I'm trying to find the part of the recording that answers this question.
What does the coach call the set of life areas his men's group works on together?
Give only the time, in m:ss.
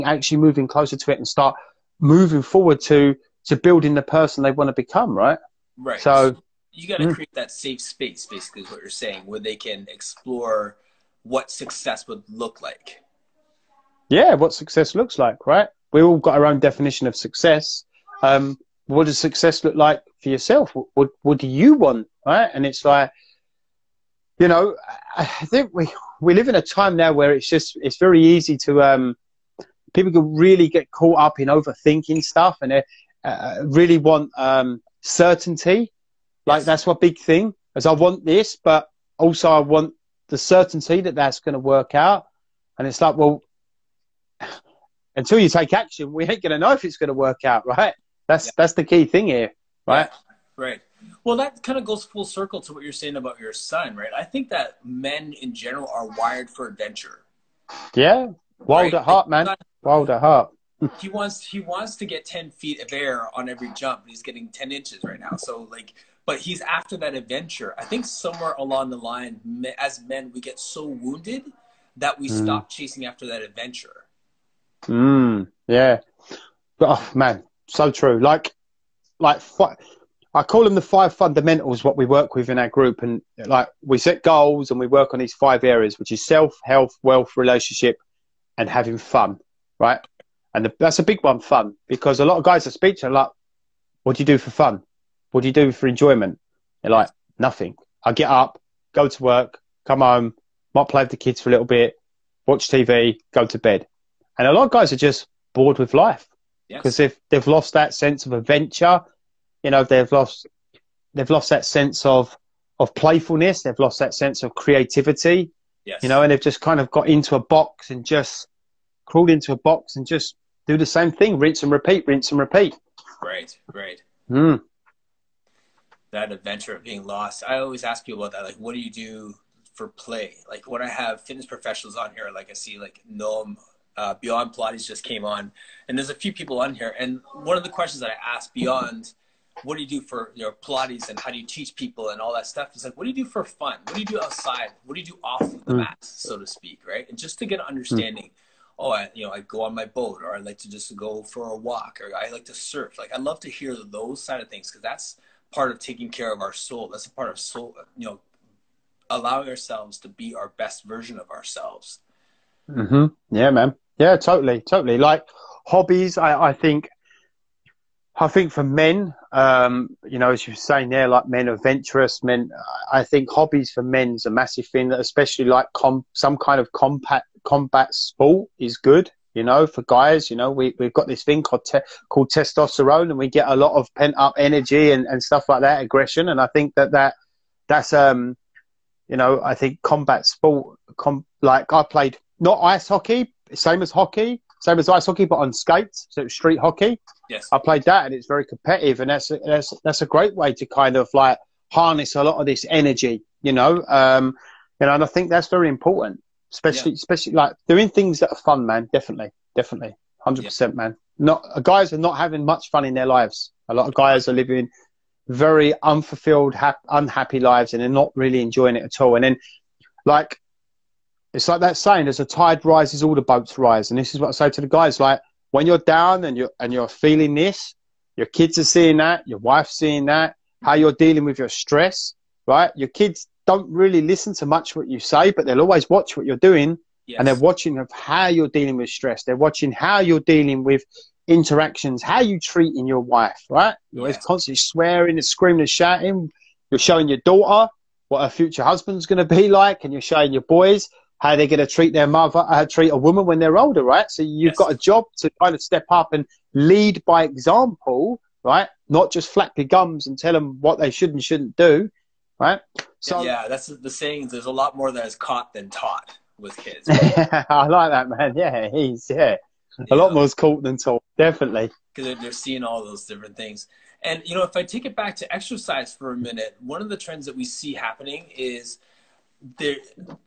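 1:20.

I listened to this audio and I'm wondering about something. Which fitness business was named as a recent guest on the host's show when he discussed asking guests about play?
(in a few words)
Beyond Pilates.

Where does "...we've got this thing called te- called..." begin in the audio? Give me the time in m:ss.
3:00.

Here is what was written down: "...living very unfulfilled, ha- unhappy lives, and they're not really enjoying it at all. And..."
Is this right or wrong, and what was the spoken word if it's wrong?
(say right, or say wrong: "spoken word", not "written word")
right.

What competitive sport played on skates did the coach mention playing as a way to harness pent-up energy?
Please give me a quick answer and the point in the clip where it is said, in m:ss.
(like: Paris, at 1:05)
Street hockey, at 3:16.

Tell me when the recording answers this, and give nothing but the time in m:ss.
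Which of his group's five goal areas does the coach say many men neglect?
1:28.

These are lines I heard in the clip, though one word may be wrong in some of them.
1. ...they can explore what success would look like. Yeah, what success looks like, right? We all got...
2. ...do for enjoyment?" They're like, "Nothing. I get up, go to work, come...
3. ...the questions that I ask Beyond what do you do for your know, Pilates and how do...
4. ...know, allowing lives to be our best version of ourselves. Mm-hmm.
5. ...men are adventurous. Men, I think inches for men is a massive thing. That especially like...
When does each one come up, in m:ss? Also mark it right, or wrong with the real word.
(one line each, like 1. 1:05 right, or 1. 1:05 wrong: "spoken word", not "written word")
1. 0:09 right
2. 1:35 right
3. 2:17 right
4. 2:38 wrong: "ourselves", not "lives"
5. 2:51 wrong: "hobbies", not "inches".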